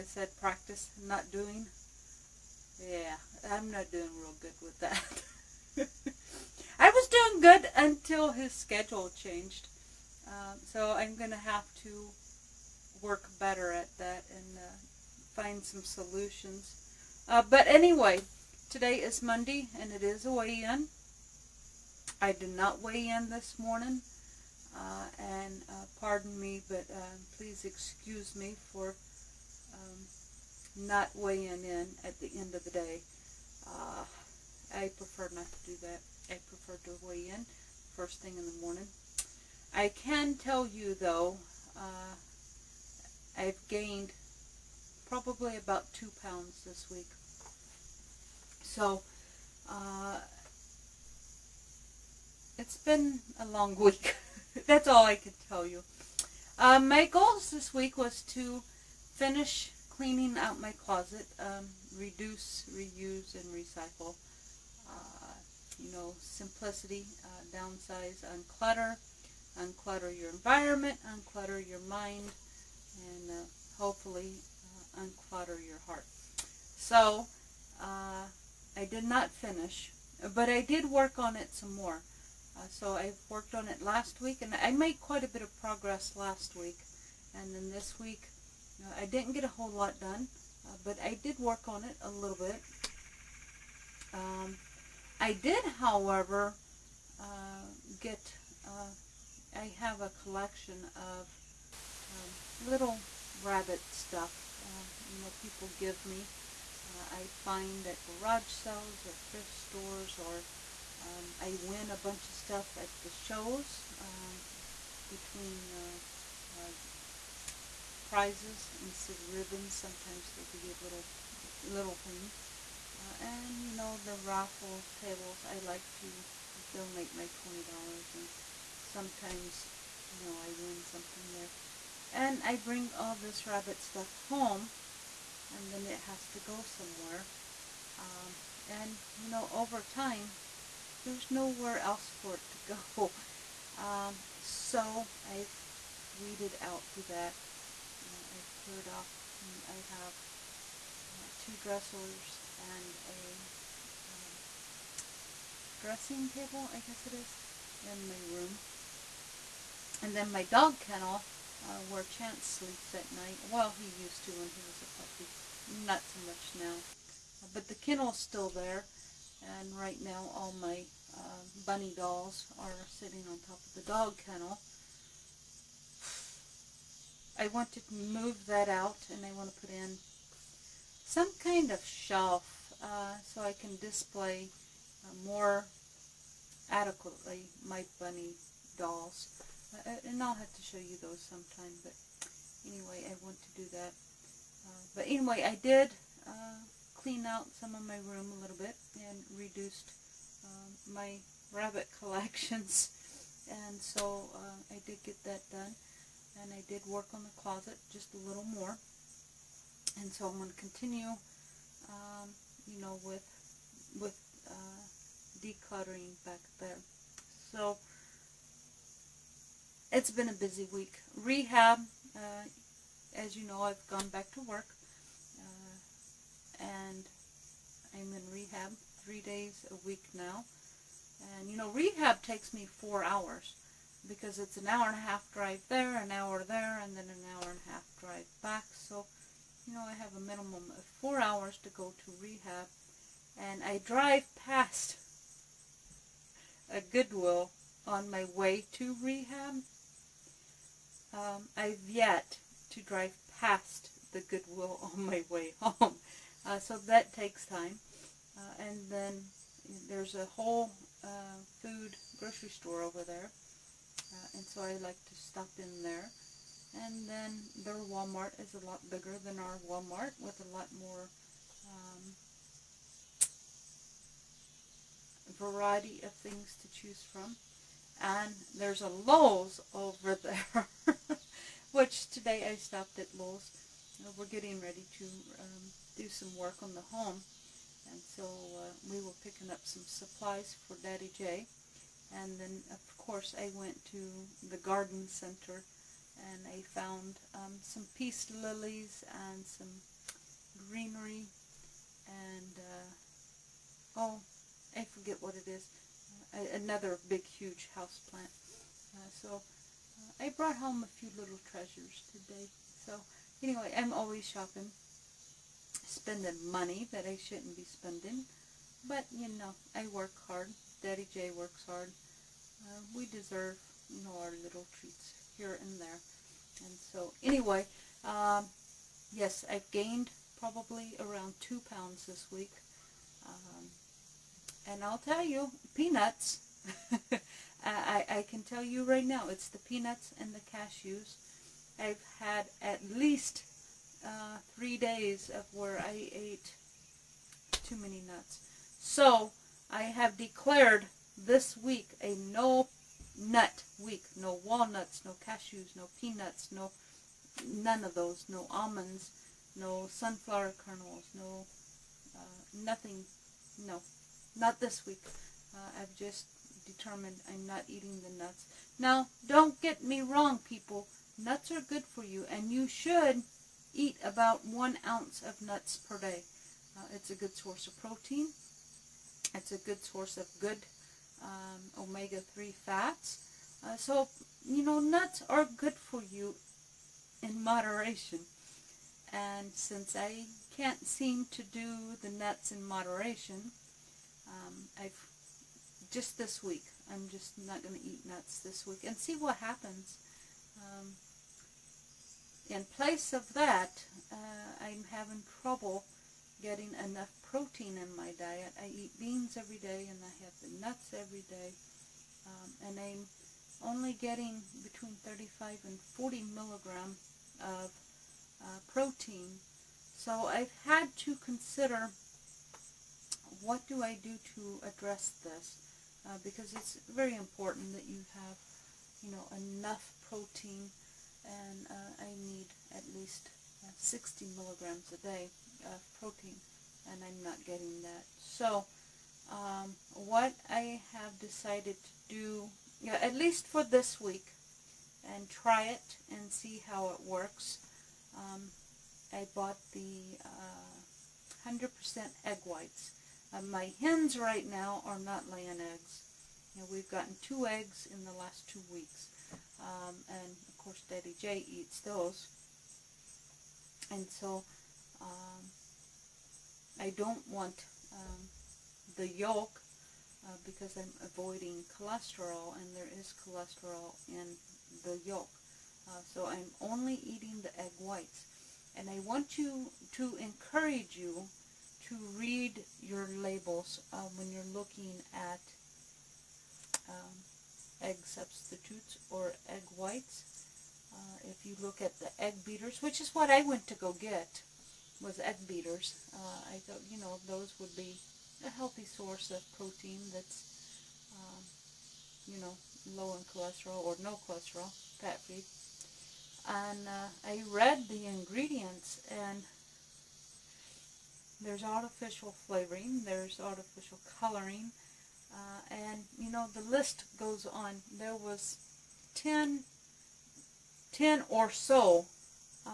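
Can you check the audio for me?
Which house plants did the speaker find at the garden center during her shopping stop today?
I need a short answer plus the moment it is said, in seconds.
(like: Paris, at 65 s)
peace lilies, at 297 s.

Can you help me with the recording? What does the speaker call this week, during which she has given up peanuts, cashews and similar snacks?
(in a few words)
no nut week.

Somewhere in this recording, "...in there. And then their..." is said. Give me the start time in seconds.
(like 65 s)
265 s.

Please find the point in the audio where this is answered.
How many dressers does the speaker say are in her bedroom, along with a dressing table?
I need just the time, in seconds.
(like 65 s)
151 s.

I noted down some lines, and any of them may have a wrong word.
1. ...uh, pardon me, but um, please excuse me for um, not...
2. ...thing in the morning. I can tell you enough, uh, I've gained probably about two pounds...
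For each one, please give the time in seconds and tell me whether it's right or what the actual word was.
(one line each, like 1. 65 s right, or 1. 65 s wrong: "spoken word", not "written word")
1. 25 s right
2. 38 s wrong: "though", not "enough".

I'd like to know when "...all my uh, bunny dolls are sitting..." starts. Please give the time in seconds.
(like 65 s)
170 s.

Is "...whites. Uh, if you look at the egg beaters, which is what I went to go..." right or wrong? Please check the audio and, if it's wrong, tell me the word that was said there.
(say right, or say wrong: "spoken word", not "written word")
right.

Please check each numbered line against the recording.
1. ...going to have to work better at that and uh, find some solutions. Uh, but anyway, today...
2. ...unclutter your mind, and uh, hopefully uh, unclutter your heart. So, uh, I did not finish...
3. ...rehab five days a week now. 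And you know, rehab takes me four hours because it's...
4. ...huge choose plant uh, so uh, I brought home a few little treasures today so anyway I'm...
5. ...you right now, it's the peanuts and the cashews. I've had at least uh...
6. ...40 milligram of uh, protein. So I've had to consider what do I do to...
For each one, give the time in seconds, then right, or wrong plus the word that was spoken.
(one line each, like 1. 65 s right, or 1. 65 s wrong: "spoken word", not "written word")
1. 11 s right
2. 71 s right
3. 228 s wrong: "three", not "five"
4. 307 s wrong: "house", not "choose"
5. 338 s right
6. 415 s right.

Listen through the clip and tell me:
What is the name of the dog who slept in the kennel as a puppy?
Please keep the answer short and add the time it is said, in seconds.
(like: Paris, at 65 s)
Chance, at 162 s.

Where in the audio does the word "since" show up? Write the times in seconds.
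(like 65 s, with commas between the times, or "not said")
389 s.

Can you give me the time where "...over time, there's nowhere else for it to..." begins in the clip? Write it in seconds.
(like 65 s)
139 s.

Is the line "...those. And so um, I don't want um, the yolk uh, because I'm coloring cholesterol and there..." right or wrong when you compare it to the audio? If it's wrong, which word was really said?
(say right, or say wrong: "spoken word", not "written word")
wrong: "avoiding", not "coloring".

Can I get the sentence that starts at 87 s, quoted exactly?
And then this week, I didn't get a whole lot done, uh, but I did work on it a little bit.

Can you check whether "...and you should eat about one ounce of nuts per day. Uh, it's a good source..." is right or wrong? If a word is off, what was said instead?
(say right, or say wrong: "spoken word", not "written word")
right.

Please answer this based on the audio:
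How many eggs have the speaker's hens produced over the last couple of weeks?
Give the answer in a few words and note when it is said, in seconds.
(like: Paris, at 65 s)
2, at 457 s.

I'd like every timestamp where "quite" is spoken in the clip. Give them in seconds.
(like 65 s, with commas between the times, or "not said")
85 s.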